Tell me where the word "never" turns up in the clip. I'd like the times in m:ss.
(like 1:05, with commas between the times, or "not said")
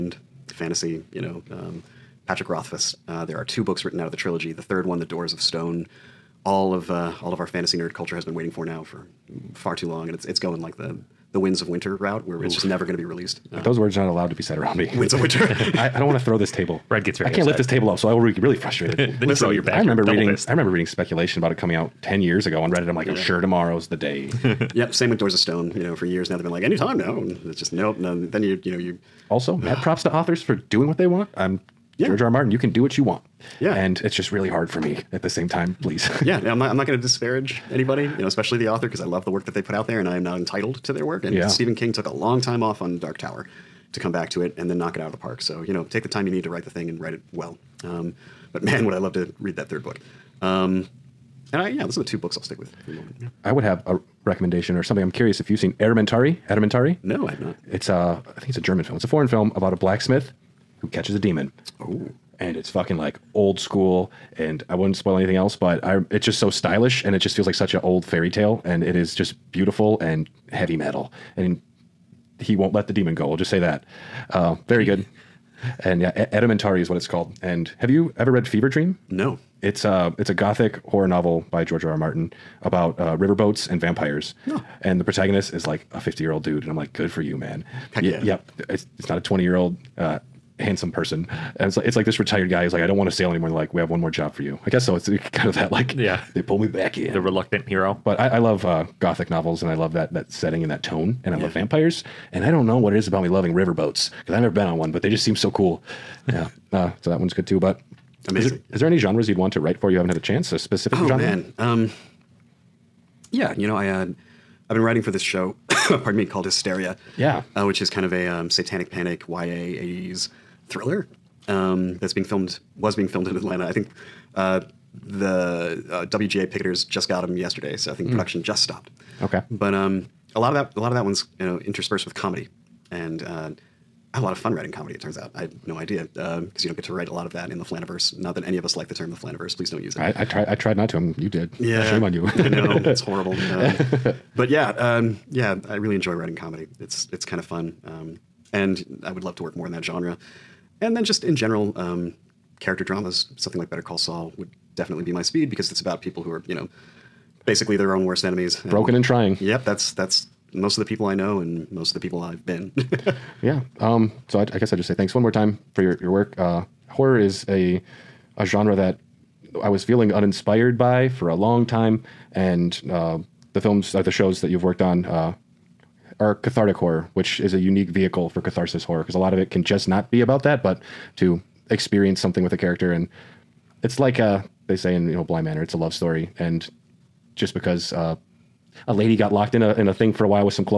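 0:12, 1:44.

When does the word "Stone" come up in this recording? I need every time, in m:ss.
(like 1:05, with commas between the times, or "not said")
0:05, 0:25.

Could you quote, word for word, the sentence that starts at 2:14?
It turns out I had no idea because um, you don't get to write a lot of that in the Flaniverse.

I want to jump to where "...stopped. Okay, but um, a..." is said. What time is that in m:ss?
2:08.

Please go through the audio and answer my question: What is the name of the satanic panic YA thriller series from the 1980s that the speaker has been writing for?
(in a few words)
Hysteria.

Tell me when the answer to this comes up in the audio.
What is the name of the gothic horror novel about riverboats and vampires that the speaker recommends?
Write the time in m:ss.
1:18.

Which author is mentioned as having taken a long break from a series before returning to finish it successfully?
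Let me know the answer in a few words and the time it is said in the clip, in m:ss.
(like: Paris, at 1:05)
Stephen King, at 0:41.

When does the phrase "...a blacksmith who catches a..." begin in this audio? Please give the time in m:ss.
0:59.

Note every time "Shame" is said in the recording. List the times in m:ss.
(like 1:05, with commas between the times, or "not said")
2:21.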